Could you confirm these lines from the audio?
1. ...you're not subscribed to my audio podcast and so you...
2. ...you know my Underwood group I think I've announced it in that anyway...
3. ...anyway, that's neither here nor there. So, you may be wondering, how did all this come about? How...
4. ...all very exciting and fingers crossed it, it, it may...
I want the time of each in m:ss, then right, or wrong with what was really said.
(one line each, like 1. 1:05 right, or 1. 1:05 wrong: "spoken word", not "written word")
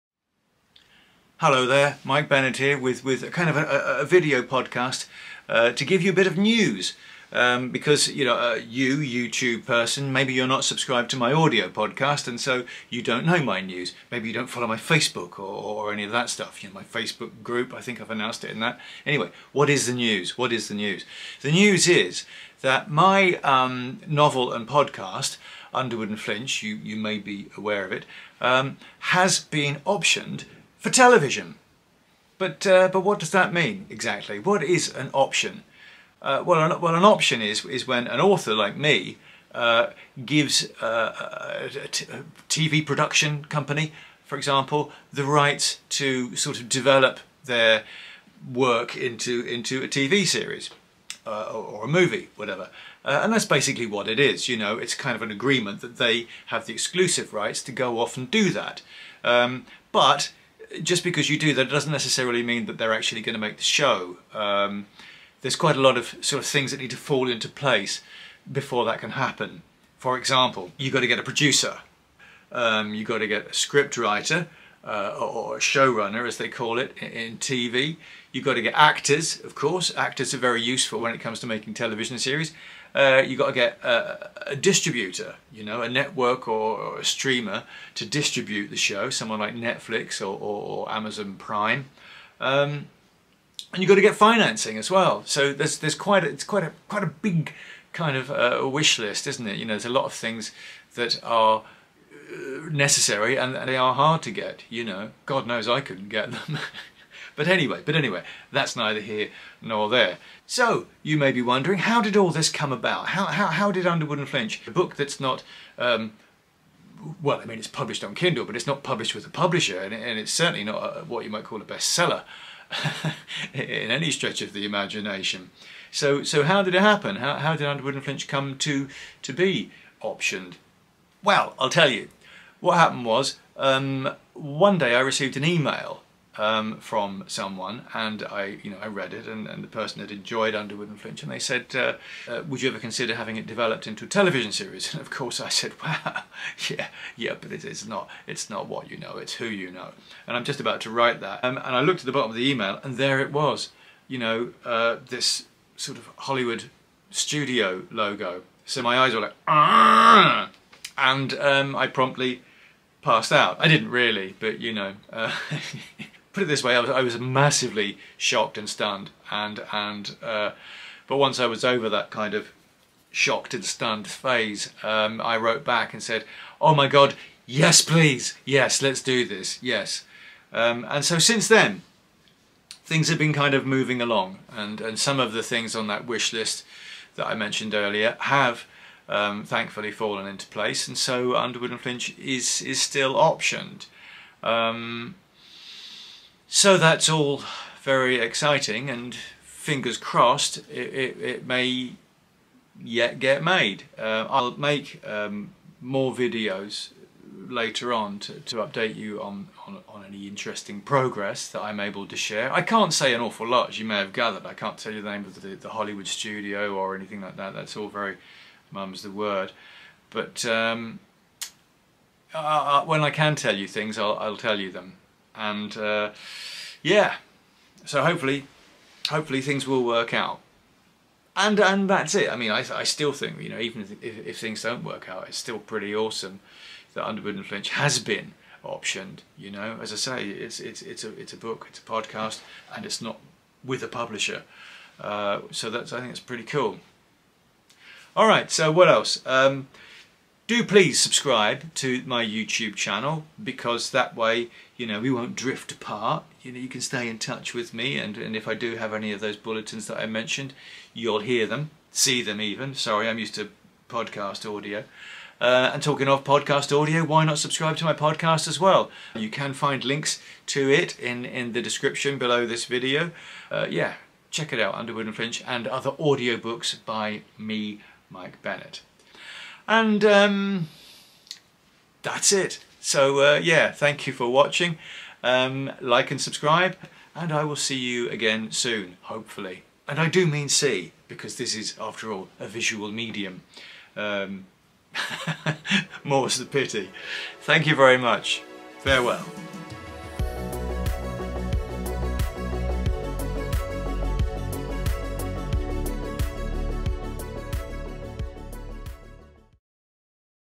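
1. 0:10 right
2. 0:16 wrong: "Facebook", not "Underwood"
3. 1:47 right
4. 3:17 right.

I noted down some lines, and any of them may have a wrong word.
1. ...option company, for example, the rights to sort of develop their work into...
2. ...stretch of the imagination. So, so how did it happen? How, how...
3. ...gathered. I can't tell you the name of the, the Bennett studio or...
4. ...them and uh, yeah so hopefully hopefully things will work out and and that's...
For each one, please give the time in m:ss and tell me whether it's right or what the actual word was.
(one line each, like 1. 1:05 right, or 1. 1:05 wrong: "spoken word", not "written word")
1. 0:42 wrong: "production", not "option"
2. 2:04 right
3. 3:34 wrong: "Hollywood", not "Bennett"
4. 3:44 right.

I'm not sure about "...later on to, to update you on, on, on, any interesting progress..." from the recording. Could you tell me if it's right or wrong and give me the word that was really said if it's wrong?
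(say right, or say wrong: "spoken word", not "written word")
right.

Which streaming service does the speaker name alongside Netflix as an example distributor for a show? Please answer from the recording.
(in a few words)
Amazon Prime.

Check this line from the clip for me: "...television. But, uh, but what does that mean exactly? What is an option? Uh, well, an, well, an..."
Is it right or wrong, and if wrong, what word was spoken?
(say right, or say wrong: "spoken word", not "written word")
right.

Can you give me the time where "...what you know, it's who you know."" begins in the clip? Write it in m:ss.
2:28.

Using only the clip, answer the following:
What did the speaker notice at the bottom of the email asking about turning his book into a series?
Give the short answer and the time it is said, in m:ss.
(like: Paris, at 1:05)
Hollywood studio logo, at 2:36.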